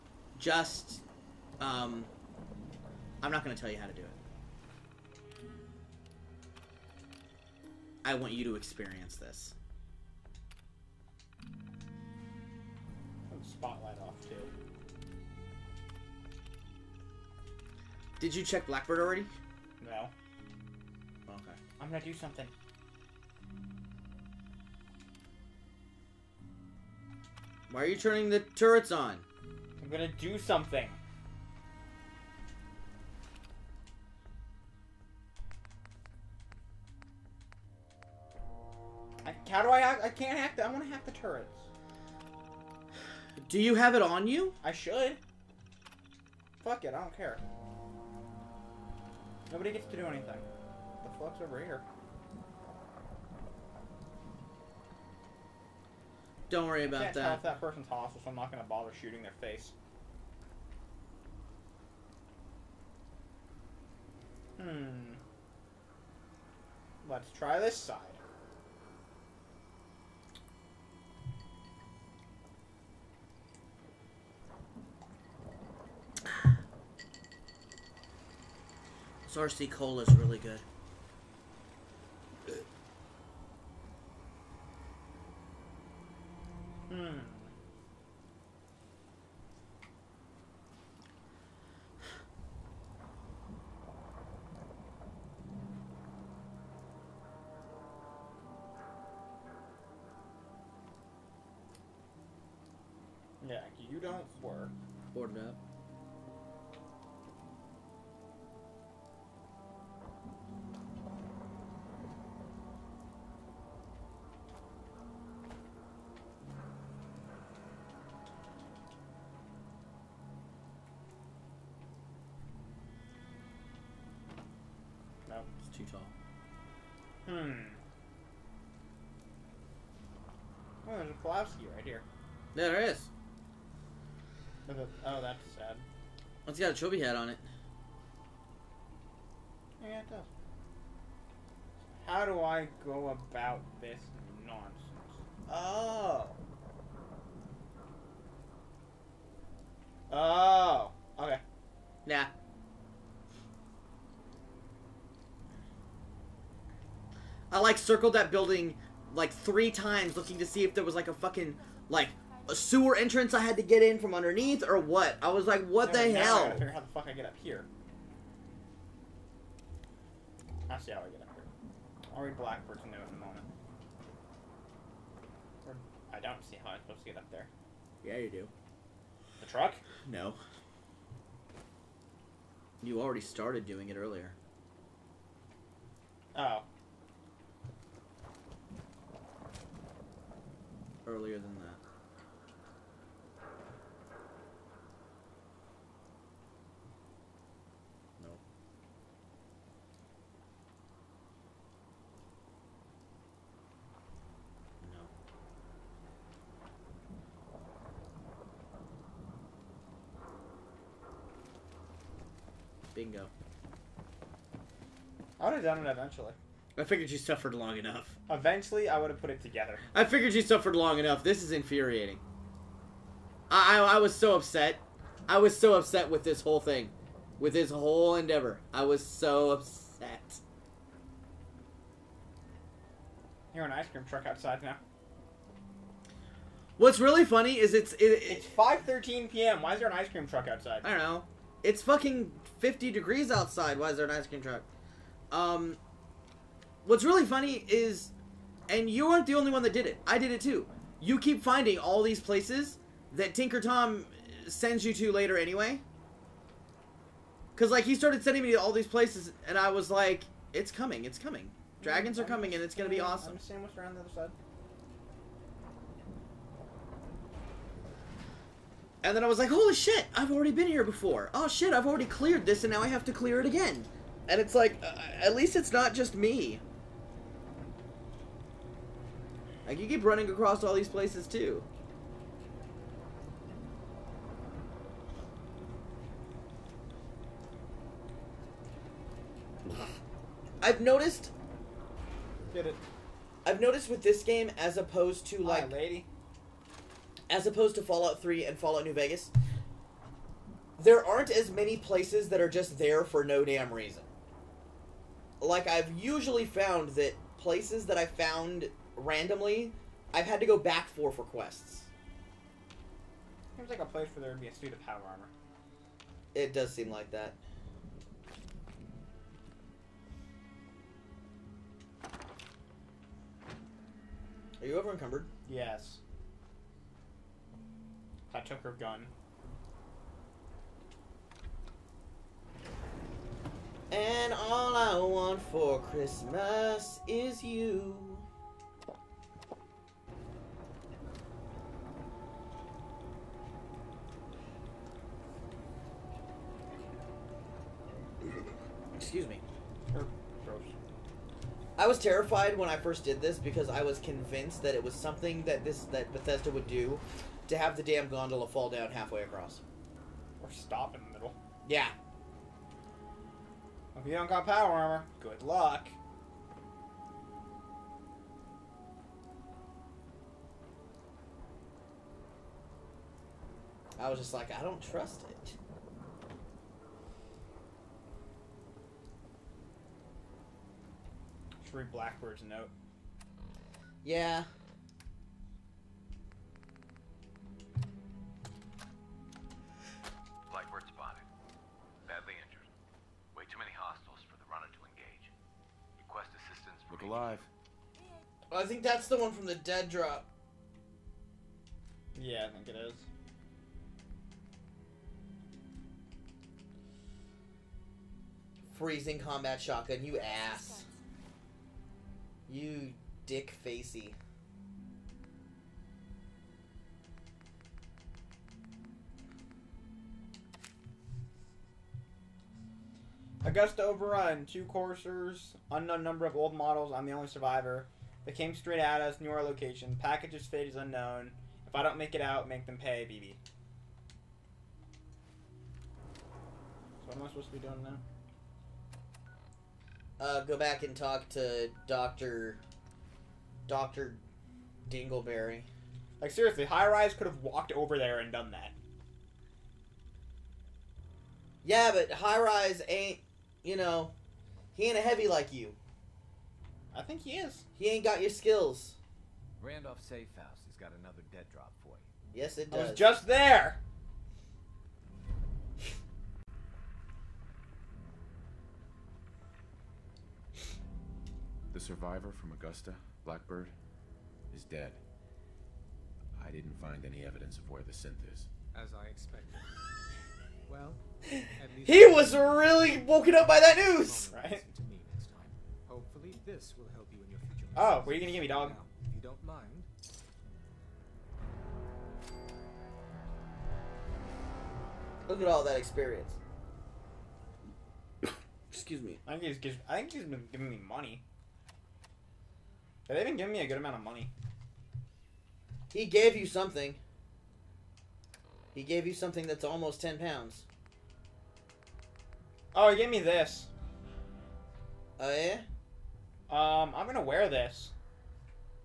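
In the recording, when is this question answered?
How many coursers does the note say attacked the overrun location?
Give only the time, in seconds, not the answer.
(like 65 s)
424 s.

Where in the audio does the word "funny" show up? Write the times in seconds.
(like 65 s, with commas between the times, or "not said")
237 s, 247 s.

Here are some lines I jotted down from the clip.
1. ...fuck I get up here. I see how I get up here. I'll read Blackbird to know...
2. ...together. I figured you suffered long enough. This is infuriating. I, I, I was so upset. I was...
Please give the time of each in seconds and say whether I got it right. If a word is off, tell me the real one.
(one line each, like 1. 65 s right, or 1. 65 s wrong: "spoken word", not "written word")
1. 166 s right
2. 219 s right.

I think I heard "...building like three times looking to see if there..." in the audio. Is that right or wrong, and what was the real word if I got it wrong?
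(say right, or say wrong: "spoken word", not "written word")
right.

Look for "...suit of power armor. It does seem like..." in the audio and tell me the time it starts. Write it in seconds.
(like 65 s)
314 s.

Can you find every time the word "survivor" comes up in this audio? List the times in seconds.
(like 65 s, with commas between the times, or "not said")
427 s, 471 s.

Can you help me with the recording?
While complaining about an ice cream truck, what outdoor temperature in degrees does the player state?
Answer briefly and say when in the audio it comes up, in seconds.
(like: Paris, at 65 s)
50, at 242 s.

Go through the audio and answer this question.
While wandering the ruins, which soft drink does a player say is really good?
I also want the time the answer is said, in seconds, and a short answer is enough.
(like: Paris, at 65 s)
Sarsi Cola, at 79 s.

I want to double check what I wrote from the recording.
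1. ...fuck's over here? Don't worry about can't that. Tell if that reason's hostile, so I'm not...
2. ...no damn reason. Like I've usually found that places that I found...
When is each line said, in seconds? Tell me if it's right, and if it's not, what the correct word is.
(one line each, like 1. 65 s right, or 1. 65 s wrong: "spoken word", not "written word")
1. 51 s wrong: "person", not "reason"
2. 303 s right.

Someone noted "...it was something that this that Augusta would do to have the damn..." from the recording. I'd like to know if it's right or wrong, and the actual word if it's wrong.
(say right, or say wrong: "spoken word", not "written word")
wrong: "Bethesda", not "Augusta".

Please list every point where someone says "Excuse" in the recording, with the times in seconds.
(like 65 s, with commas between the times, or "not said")
349 s, 498 s.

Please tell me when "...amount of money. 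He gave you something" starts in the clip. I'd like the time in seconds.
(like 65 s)
503 s.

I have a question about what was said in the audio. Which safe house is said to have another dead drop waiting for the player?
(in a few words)
Randolph Safe House.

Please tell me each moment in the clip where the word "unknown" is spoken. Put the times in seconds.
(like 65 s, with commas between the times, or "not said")
425 s, 430 s.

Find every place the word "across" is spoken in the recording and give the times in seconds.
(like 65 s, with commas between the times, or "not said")
280 s, 359 s.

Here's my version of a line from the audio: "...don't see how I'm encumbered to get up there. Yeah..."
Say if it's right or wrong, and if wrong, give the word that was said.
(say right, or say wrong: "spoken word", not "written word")
wrong: "supposed", not "encumbered".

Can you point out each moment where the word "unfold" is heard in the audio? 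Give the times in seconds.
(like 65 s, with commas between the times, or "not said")
not said.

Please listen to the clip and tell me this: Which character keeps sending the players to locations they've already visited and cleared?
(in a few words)
Tinker Tom.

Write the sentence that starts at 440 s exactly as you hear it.
uh, go back and talk to Doctor Doctor Dingleberry.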